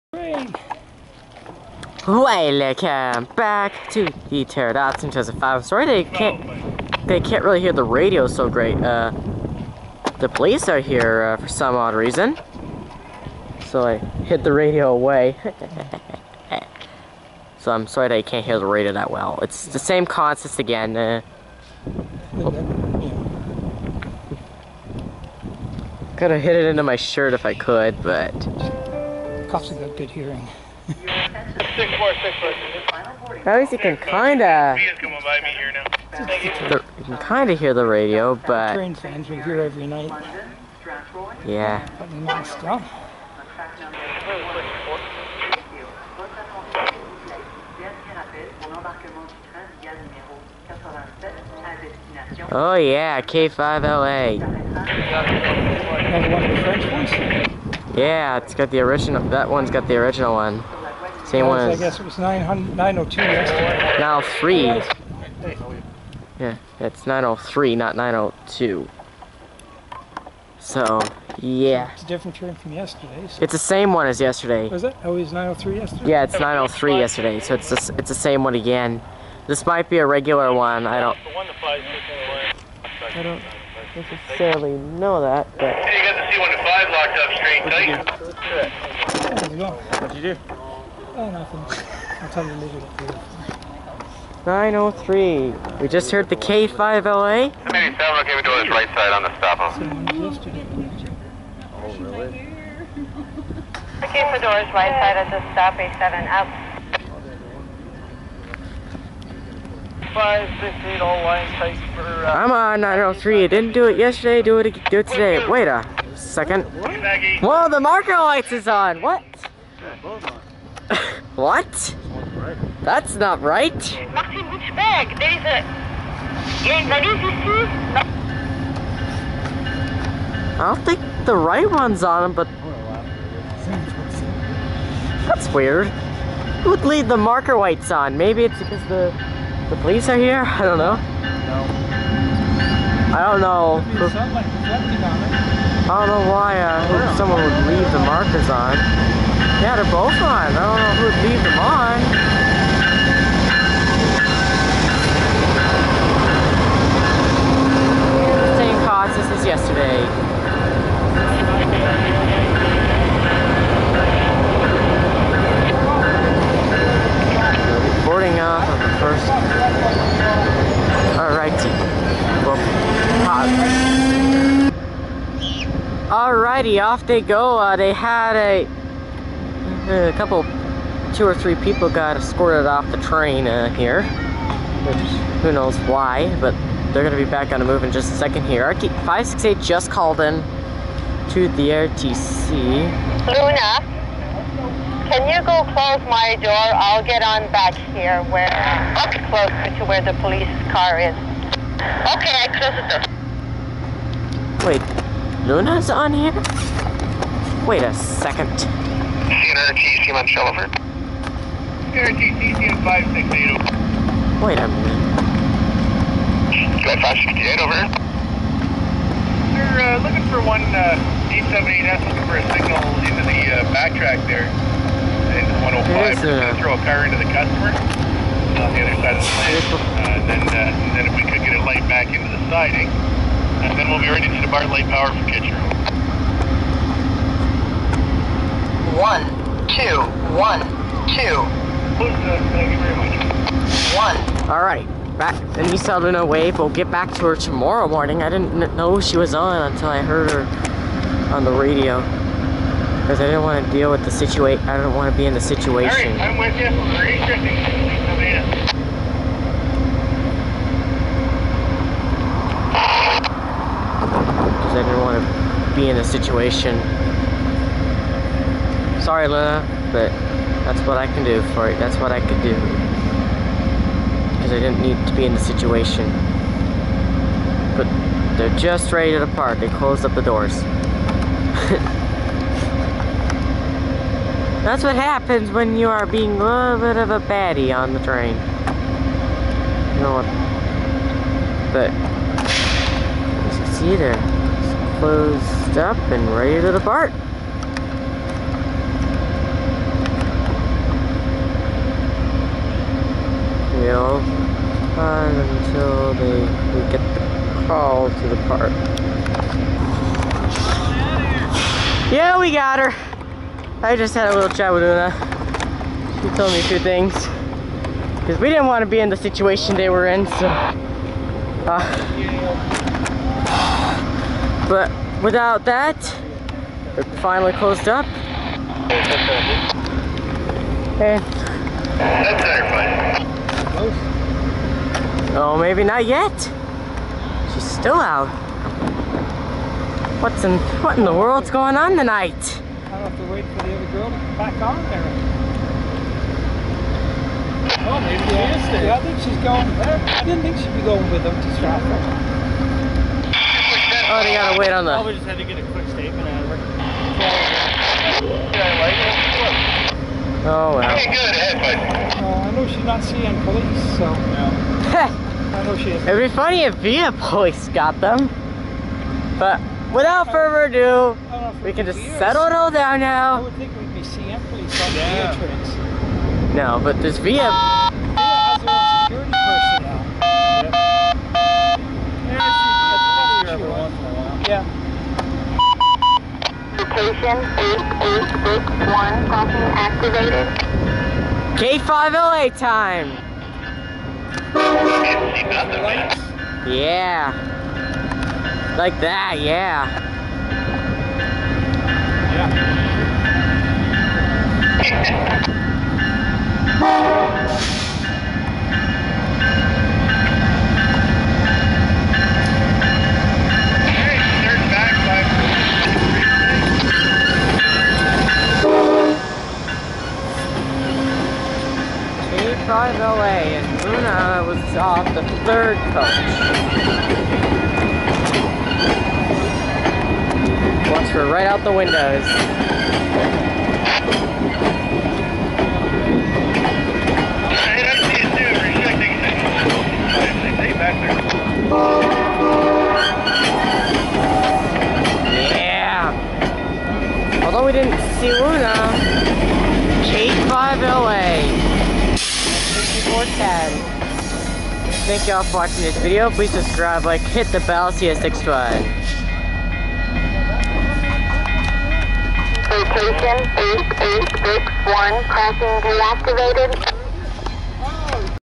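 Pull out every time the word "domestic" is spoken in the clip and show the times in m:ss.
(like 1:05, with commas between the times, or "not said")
not said.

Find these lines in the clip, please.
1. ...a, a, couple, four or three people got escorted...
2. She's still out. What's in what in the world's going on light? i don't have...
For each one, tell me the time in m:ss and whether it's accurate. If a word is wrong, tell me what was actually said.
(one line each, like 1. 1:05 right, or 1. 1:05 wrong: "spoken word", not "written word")
1. 2:58 wrong: "two", not "four"
2. 5:37 wrong: "tonight", not "light".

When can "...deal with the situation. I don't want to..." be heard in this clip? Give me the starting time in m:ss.
4:13.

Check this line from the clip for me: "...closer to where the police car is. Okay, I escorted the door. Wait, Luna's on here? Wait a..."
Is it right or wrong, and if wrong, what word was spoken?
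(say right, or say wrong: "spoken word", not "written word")
wrong: "closed", not "escorted".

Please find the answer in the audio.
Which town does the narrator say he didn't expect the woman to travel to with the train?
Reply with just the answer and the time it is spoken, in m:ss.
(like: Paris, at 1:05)
Stratford, at 5:51.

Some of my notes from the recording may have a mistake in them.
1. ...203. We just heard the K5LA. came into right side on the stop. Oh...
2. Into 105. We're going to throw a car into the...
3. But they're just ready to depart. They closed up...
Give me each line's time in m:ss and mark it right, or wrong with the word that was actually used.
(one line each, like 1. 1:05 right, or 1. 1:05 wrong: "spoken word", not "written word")
1. 1:34 wrong: "903", not "203"
2. 3:45 right
3. 4:37 right.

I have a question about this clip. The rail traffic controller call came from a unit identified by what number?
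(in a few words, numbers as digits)
568.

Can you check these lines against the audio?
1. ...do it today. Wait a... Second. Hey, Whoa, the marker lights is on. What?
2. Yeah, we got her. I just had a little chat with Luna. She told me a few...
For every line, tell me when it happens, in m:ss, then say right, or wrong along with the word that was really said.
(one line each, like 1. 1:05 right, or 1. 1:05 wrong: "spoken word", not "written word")
1. 1:54 right
2. 5:12 right.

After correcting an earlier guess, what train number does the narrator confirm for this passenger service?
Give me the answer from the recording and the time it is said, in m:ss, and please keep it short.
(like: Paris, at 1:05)
903, at 1:06.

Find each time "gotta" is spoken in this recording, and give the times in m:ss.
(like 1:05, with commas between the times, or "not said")
5:54.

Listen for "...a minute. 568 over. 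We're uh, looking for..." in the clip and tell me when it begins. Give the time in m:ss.
3:34.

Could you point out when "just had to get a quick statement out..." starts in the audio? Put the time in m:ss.
5:55.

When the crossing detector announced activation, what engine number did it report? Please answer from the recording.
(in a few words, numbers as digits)
8861.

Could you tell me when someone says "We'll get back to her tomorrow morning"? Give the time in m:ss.
4:06.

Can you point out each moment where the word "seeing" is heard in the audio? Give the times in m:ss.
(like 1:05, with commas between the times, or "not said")
6:03, 6:14.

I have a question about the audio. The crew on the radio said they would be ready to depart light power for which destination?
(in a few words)
Kitchener.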